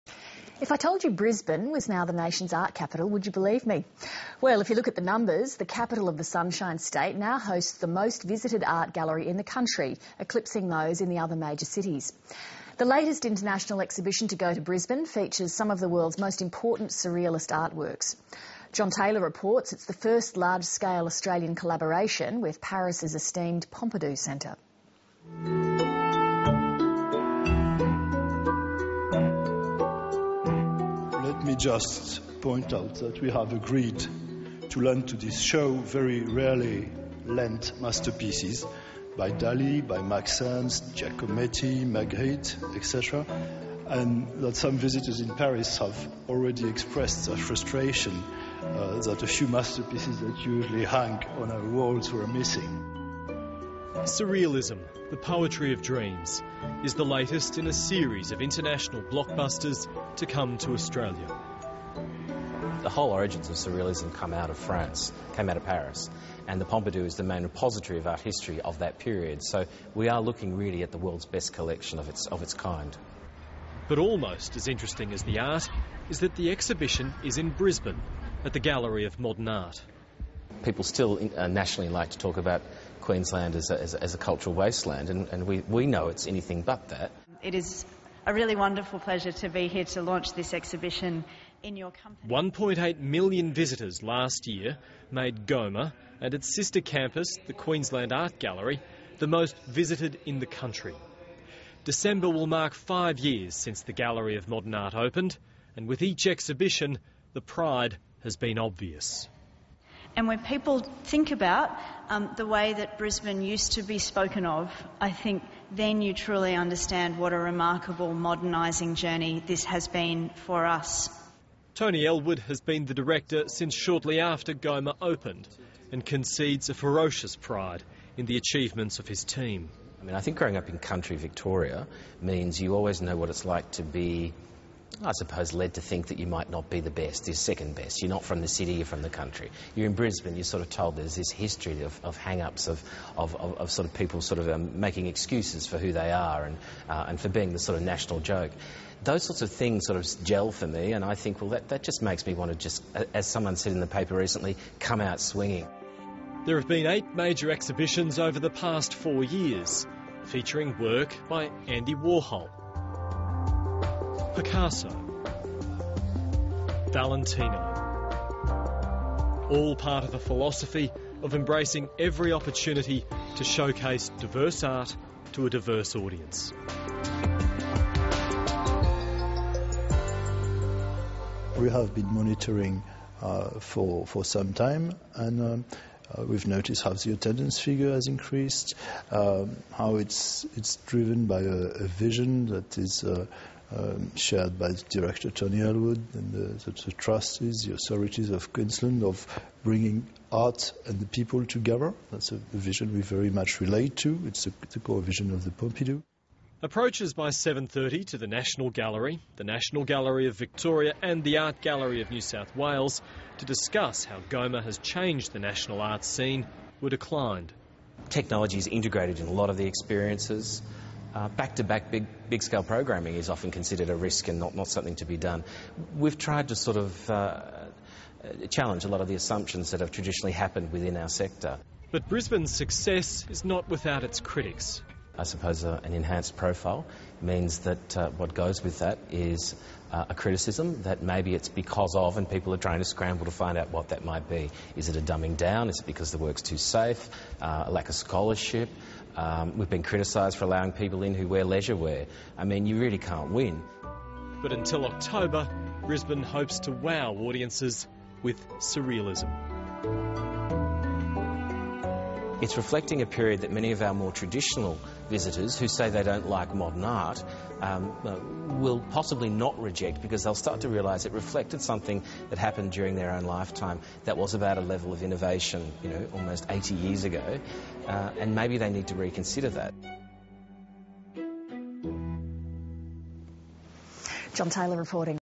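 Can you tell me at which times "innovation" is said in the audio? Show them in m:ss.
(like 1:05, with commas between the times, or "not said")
4:35.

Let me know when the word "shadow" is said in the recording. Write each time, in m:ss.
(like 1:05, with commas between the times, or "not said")
not said.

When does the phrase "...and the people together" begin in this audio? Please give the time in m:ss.
3:20.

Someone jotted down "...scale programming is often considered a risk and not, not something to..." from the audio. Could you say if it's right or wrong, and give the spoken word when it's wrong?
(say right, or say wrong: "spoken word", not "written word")
right.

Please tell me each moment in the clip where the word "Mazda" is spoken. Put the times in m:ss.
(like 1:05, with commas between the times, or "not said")
not said.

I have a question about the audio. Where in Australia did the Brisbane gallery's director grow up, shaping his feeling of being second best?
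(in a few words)
country Victoria.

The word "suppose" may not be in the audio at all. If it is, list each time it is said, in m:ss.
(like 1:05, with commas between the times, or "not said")
2:15, 3:55.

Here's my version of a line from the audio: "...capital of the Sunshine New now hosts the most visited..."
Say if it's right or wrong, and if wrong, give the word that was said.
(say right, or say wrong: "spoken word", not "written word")
wrong: "State", not "New".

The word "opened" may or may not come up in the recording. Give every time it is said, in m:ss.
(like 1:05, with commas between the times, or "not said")
1:44, 2:05.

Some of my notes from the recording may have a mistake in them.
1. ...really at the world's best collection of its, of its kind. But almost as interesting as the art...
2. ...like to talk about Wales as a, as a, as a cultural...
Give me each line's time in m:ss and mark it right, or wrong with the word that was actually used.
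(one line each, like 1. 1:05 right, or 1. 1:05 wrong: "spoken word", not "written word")
1. 1:10 right
2. 1:21 wrong: "Queensland", not "Wales".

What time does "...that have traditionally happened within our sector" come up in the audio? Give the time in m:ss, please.
3:49.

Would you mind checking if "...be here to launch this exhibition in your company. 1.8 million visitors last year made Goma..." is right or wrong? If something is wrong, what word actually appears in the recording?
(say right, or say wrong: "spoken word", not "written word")
right.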